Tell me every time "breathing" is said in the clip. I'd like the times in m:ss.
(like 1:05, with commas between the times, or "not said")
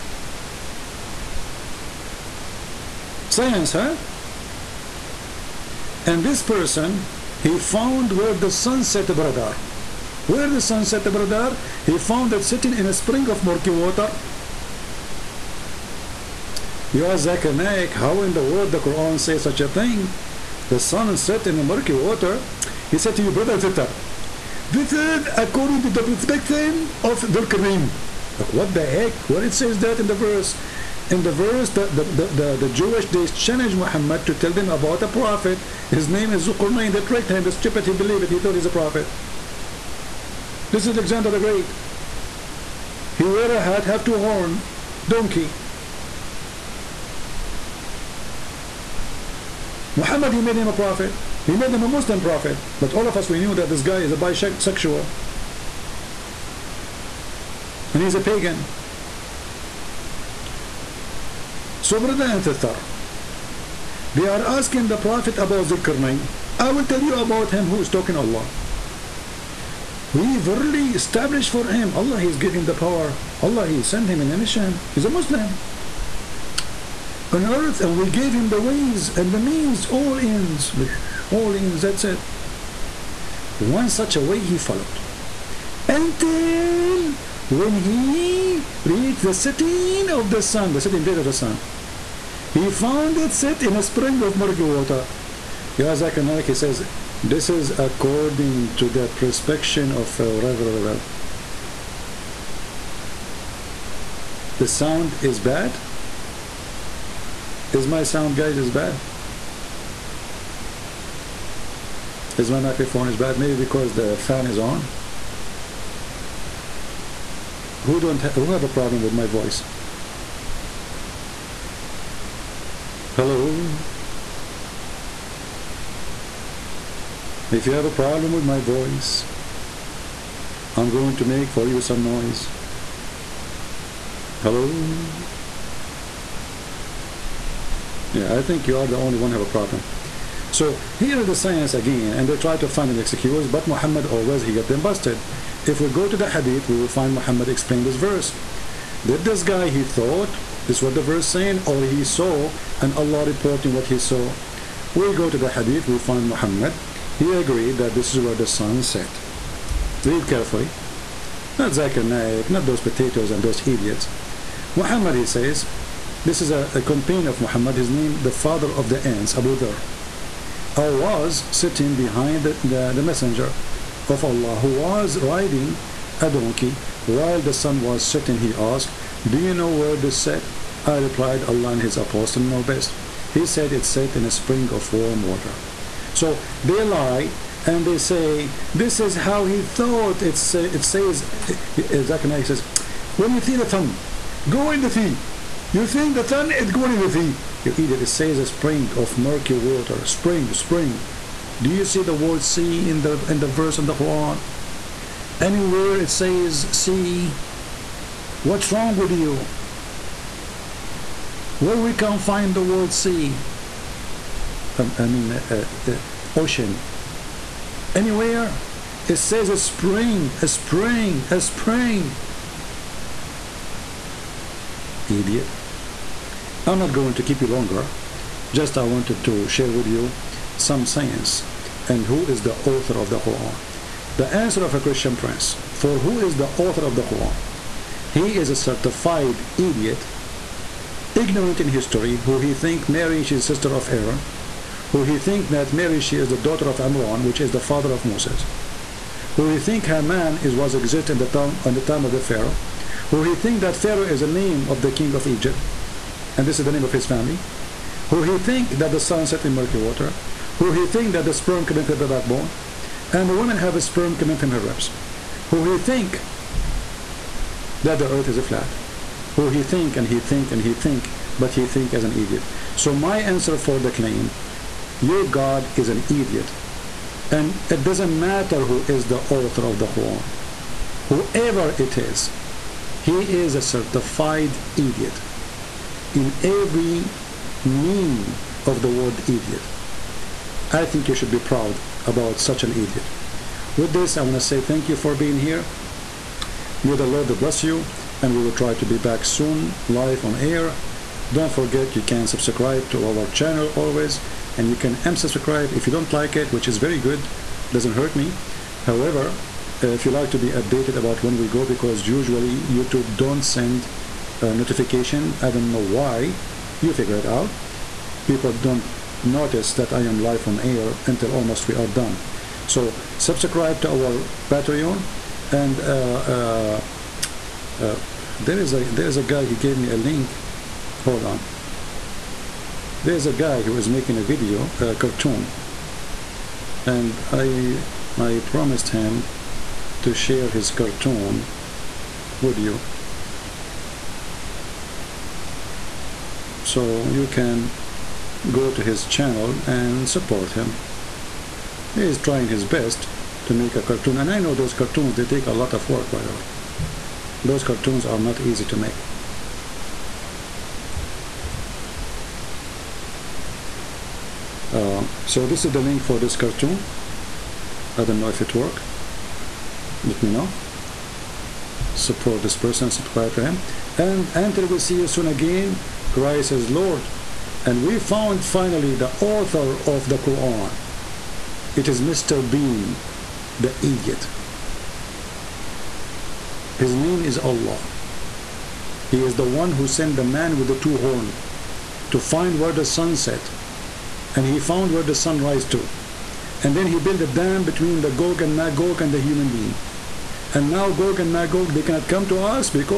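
not said.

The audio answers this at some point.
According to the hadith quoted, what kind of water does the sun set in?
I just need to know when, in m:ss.
3:04.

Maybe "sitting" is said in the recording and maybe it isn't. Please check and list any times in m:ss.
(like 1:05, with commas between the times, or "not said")
0:12, 2:51.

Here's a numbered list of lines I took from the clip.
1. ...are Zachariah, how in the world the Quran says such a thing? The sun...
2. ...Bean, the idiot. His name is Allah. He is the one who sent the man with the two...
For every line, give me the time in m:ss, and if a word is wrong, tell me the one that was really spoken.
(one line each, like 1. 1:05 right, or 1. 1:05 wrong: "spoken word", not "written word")
1. 0:17 right
2. 6:22 right.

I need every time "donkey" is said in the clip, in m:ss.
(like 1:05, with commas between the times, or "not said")
0:45, 2:56.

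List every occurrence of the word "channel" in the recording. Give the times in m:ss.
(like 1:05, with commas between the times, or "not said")
5:03, 5:49.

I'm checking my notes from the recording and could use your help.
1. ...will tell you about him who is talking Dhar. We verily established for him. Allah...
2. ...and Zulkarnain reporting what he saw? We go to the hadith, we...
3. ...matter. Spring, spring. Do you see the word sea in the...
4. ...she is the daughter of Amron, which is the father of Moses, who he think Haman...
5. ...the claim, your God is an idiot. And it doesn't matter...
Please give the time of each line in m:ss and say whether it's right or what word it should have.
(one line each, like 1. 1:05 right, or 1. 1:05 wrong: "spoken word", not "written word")
1. 1:06 wrong: "Allah", not "Dhar"
2. 2:32 wrong: "Allah", not "Zulkarnain"
3. 3:19 wrong: "water", not "matter"
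4. 4:05 right
5. 4:33 right.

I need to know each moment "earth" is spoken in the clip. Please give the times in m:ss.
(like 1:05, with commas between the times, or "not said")
1:17, 4:28.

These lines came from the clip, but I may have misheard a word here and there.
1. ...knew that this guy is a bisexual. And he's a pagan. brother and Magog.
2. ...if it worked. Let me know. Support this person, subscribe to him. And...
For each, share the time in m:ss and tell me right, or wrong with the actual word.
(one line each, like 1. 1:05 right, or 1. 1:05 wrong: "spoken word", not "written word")
1. 0:53 wrong: "Thithar", not "Magog"
2. 6:08 right.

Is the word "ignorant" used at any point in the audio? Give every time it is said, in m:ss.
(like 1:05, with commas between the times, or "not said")
4:01.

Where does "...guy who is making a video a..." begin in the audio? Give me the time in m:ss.
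5:33.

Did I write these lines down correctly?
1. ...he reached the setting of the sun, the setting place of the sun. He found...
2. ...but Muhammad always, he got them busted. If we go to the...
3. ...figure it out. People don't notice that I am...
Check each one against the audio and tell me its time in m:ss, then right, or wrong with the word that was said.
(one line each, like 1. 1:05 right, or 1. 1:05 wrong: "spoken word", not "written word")
1. 1:27 right
2. 2:23 right
3. 5:16 right.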